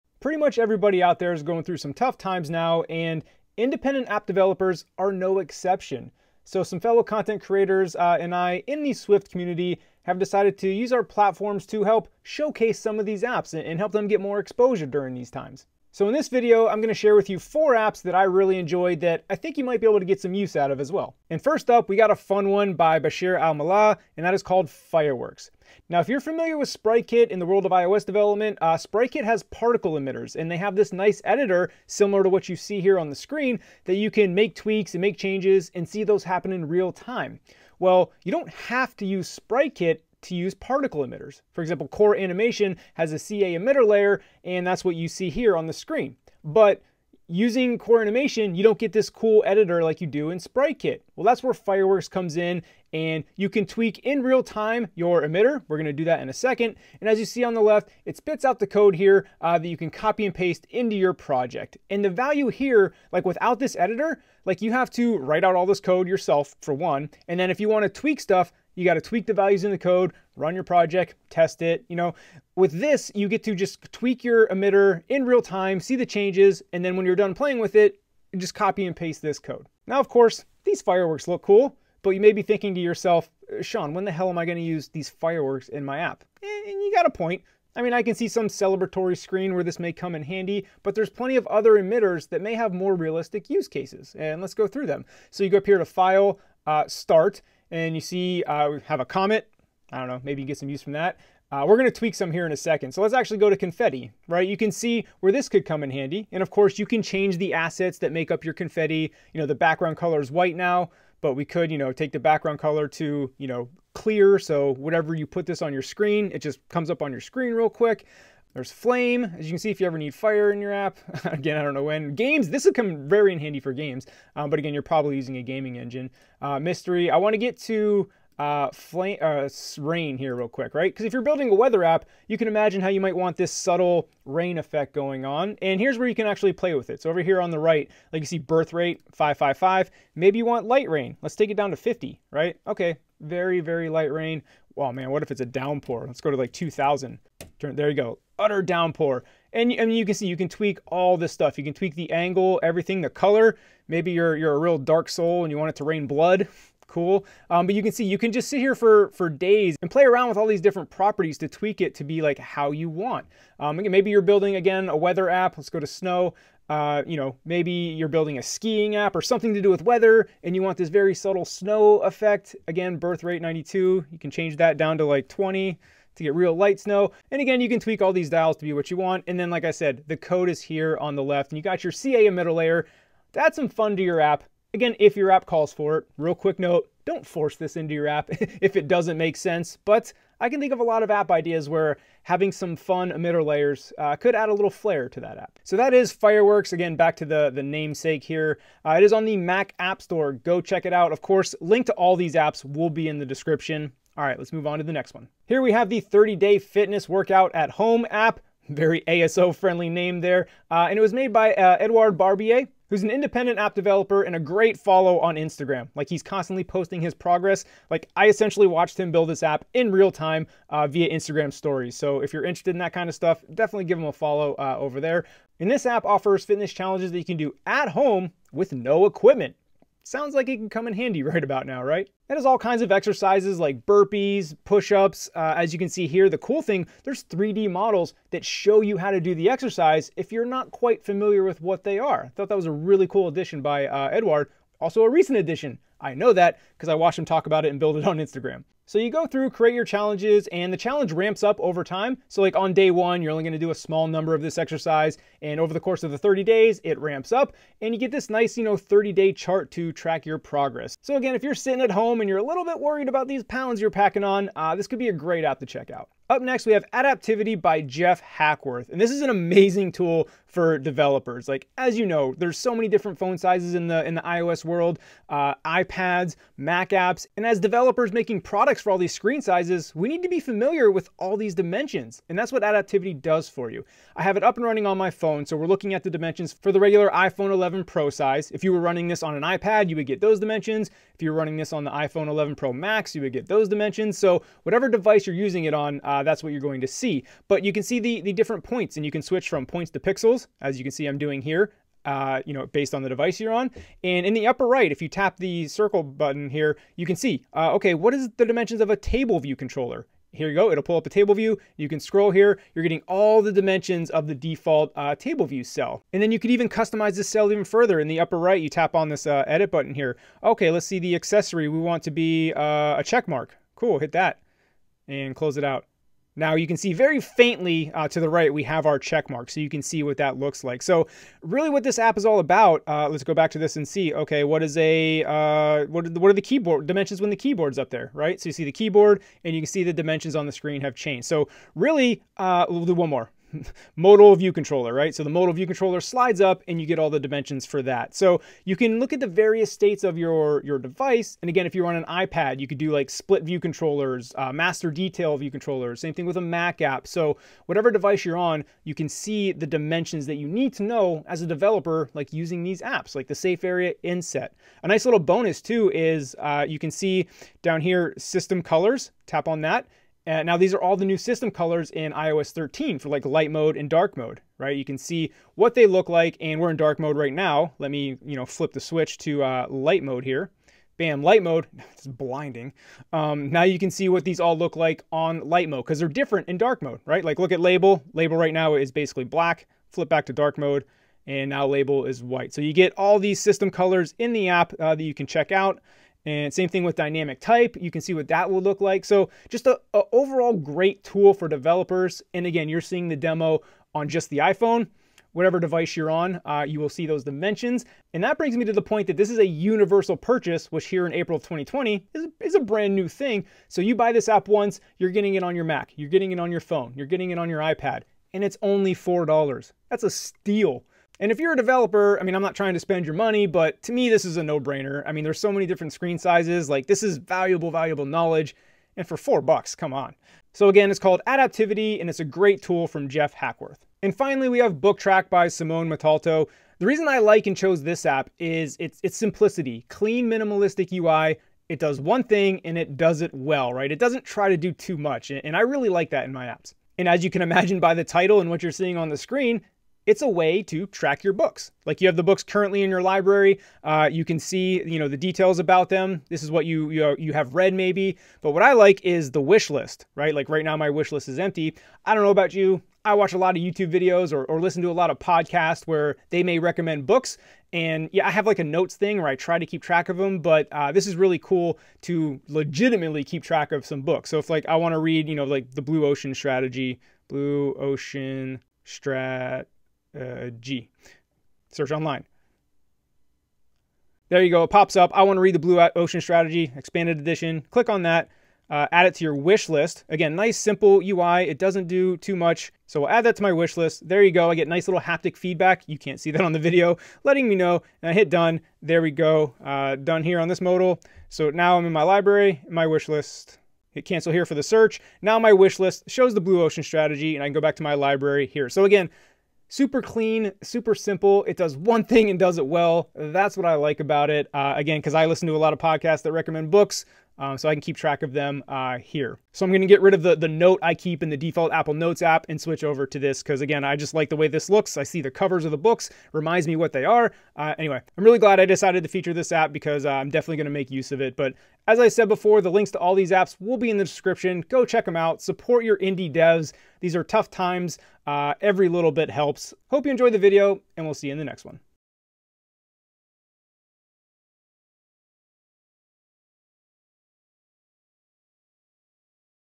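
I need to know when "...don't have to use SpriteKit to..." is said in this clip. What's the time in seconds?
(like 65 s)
38 s.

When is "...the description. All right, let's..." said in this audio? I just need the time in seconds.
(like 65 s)
203 s.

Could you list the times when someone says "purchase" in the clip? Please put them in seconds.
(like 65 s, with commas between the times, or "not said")
410 s.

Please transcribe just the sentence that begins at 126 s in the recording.
Uh, mystery, I want to get to uh, flame, uh, rain here real quick, right?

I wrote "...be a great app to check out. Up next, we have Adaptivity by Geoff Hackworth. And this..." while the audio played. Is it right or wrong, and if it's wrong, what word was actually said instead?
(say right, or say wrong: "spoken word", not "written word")
right.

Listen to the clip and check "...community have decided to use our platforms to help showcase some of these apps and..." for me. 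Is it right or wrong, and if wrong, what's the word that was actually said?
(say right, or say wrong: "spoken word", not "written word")
right.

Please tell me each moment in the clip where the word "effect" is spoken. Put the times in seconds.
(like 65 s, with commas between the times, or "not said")
134 s, 171 s.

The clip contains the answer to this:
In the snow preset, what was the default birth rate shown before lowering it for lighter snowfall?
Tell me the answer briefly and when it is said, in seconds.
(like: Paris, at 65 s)
92, at 173 s.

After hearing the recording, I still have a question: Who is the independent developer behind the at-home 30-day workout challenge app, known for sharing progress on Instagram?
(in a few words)
Edouard Barbier.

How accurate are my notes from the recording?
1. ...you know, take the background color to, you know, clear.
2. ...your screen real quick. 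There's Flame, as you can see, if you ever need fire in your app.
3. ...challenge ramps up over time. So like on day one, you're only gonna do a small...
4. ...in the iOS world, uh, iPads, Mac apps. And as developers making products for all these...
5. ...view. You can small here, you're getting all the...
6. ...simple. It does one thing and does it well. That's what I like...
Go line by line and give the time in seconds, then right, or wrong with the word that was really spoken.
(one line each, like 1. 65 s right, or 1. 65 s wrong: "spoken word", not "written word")
1. 111 s right
2. 117 s right
3. 250 s right
4. 274 s right
5. 311 s wrong: "scroll", not "small"
6. 510 s right.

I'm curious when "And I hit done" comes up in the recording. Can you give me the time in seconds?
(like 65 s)
498 s.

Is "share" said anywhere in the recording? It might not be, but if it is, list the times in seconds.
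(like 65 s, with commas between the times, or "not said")
16 s.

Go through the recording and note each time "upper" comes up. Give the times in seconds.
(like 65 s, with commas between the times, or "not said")
304 s, 318 s.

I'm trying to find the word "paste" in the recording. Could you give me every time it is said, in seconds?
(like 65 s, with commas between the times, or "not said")
60 s, 78 s.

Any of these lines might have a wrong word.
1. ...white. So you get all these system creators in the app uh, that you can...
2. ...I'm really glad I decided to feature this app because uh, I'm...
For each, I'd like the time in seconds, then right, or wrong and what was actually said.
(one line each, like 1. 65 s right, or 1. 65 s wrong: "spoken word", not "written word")
1. 392 s wrong: "colors", not "creators"
2. 528 s right.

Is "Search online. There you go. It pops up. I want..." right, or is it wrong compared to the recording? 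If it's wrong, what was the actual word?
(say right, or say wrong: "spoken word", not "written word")
right.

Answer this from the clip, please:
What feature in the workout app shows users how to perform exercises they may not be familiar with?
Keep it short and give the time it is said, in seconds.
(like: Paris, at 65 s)
3D models, at 237 s.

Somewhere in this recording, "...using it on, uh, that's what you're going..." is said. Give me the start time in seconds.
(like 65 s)
295 s.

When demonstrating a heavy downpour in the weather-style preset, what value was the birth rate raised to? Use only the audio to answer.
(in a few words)
2000.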